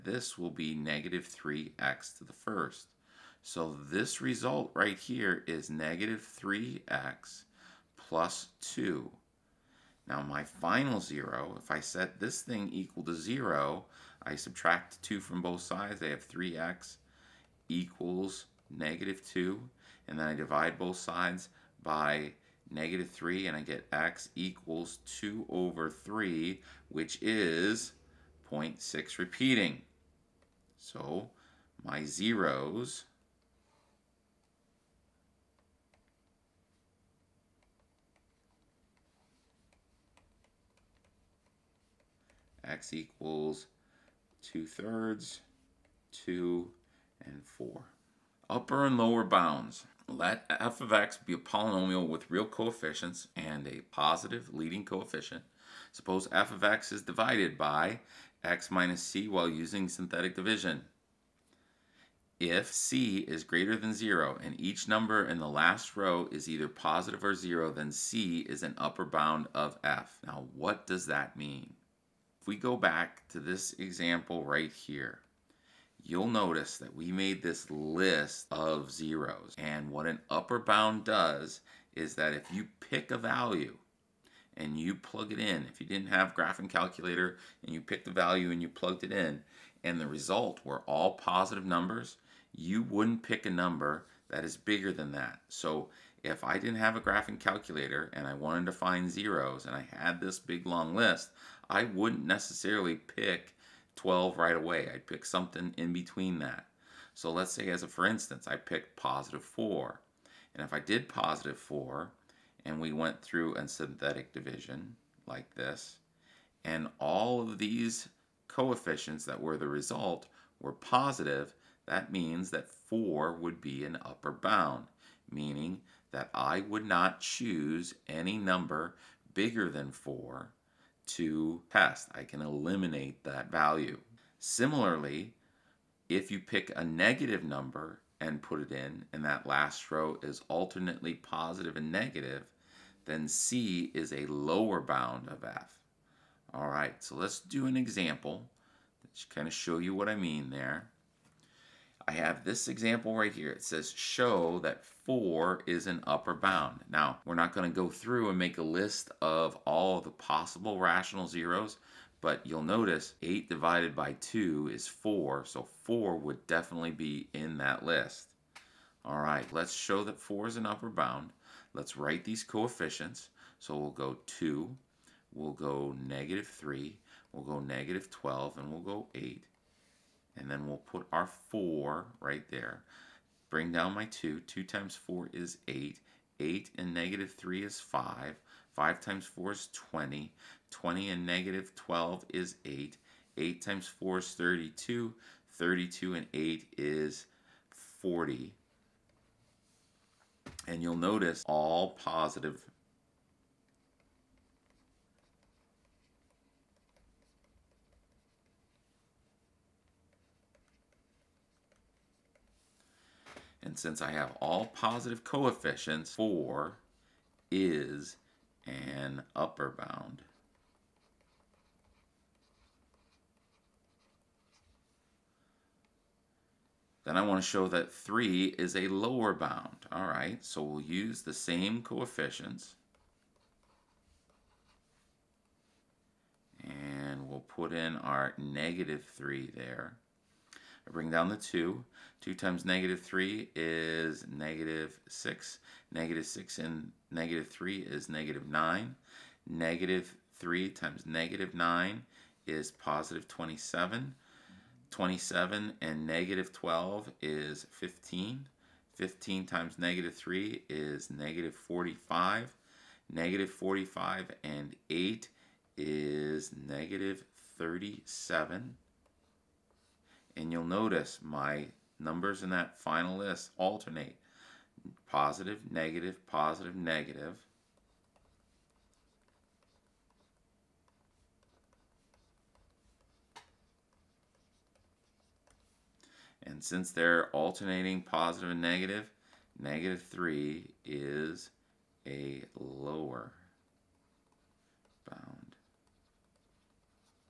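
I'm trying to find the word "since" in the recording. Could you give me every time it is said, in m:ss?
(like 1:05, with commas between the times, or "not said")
3:33, 4:46.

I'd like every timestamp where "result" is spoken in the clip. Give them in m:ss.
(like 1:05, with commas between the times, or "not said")
0:04, 1:30, 1:59.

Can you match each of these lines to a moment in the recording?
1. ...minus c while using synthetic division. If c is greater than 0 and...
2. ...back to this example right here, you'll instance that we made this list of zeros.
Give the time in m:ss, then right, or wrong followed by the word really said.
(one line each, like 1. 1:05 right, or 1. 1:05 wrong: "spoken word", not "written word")
1. 0:58 right
2. 1:12 wrong: "notice", not "instance".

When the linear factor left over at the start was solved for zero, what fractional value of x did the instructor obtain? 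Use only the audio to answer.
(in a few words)
2/3.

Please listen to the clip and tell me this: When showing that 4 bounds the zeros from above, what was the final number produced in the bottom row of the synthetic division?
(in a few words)
40.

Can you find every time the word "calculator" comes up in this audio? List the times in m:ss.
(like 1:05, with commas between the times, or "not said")
1:26, 1:37.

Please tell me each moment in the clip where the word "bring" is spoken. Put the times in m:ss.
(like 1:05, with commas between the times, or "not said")
3:03, 4:00.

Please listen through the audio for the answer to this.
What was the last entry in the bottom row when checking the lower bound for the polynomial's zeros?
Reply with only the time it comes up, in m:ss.
4:26.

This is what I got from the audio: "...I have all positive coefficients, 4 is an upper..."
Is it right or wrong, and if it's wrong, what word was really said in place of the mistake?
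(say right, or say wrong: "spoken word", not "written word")
right.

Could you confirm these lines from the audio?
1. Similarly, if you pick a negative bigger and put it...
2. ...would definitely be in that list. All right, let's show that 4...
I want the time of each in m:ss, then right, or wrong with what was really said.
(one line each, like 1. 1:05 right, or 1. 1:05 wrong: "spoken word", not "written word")
1. 2:14 wrong: "number", not "bigger"
2. 2:46 right.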